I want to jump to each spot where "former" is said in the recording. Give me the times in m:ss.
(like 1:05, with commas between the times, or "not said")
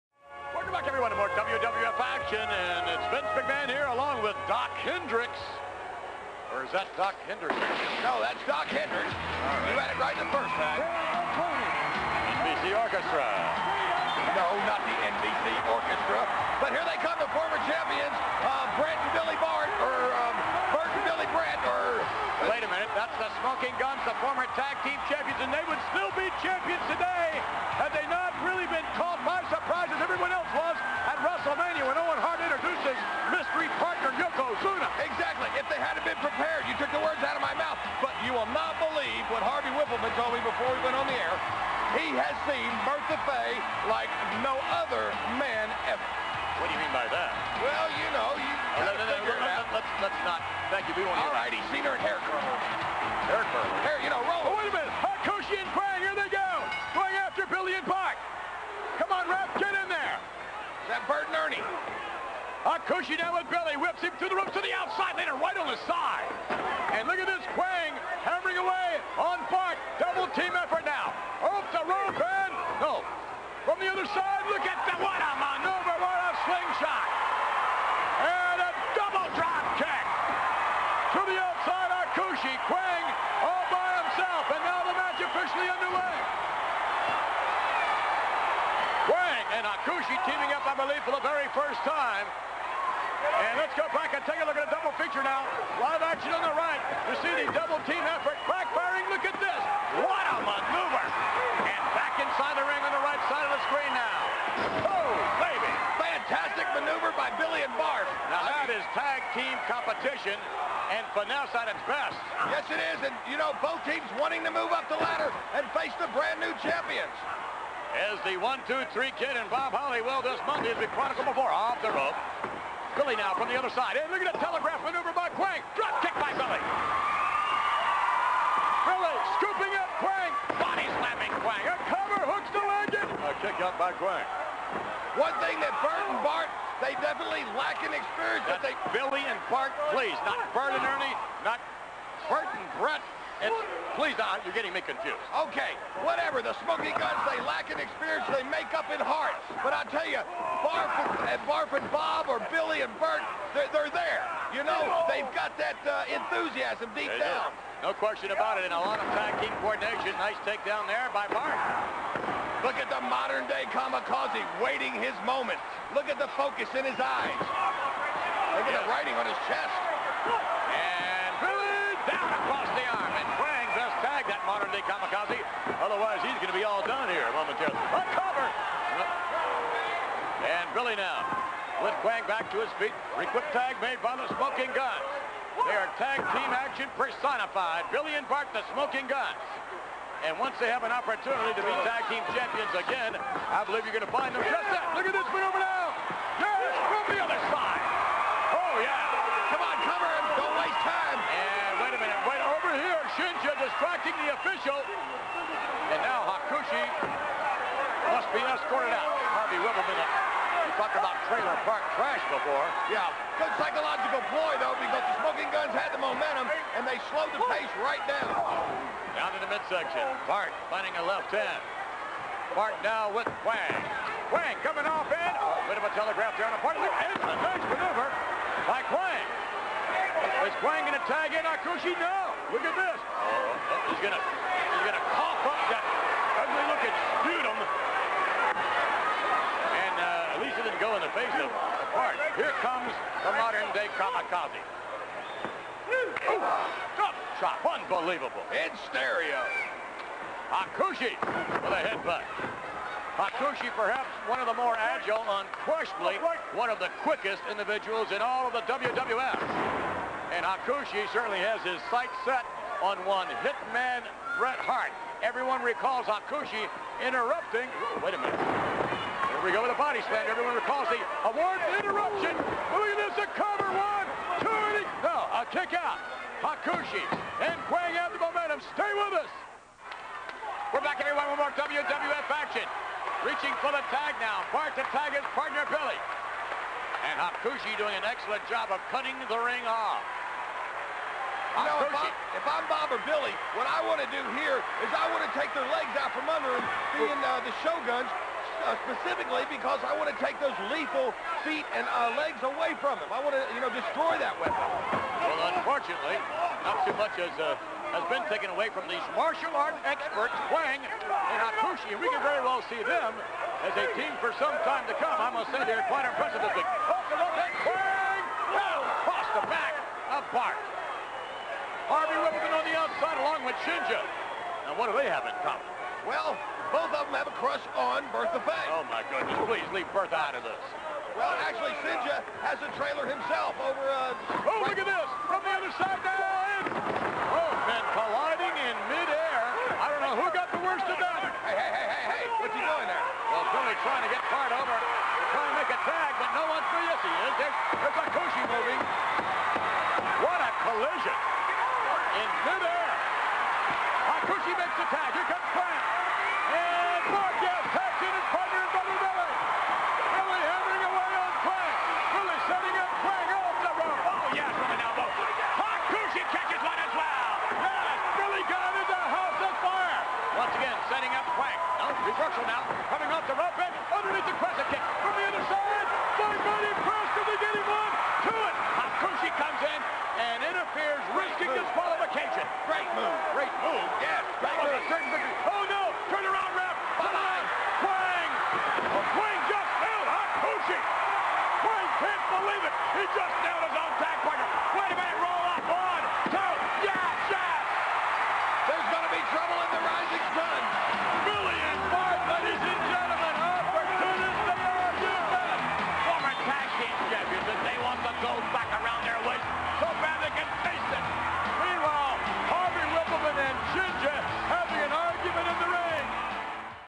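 0:17, 0:24.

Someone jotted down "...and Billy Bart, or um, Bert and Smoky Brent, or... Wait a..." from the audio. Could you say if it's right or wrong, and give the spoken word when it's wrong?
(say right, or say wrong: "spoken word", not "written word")
wrong: "Billy", not "Smoky".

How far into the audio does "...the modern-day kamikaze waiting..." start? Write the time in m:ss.
2:42.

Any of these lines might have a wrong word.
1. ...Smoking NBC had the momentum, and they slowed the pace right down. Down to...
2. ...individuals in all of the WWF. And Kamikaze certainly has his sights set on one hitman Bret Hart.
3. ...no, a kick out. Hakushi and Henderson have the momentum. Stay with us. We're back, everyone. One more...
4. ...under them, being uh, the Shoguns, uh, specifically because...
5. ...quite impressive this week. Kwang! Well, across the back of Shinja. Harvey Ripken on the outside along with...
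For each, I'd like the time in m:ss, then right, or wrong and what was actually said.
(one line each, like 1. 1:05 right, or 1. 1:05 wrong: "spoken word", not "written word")
1. 3:35 wrong: "Gunns", not "NBC"
2. 4:17 wrong: "Hakushi", not "Kamikaze"
3. 4:35 wrong: "Kwang", not "Henderson"
4. 4:56 right
5. 5:15 wrong: "Bart", not "Shinja".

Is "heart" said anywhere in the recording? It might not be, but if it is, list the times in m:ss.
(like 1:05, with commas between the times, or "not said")
2:29.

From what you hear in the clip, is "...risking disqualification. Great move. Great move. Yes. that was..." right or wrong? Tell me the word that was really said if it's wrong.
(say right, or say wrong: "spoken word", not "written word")
right.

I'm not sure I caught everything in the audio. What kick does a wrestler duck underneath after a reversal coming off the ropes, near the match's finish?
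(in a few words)
crescent kick.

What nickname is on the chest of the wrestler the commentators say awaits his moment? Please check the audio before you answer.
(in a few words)
Modern Day Kamikaze.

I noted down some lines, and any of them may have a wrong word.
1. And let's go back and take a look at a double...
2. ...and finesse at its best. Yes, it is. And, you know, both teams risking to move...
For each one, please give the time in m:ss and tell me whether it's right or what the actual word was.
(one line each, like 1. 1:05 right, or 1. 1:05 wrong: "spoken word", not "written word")
1. 1:33 right
2. 1:50 wrong: "wanting", not "risking".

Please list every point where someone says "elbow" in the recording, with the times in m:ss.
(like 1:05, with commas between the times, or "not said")
6:04.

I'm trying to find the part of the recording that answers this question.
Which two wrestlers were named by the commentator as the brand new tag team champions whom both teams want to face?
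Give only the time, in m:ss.
1:58.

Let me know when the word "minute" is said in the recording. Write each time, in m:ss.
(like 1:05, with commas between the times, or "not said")
0:22, 0:54, 3:29, 4:28, 6:34.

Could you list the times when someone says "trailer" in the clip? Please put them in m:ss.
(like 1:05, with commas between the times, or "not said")
3:31, 5:32.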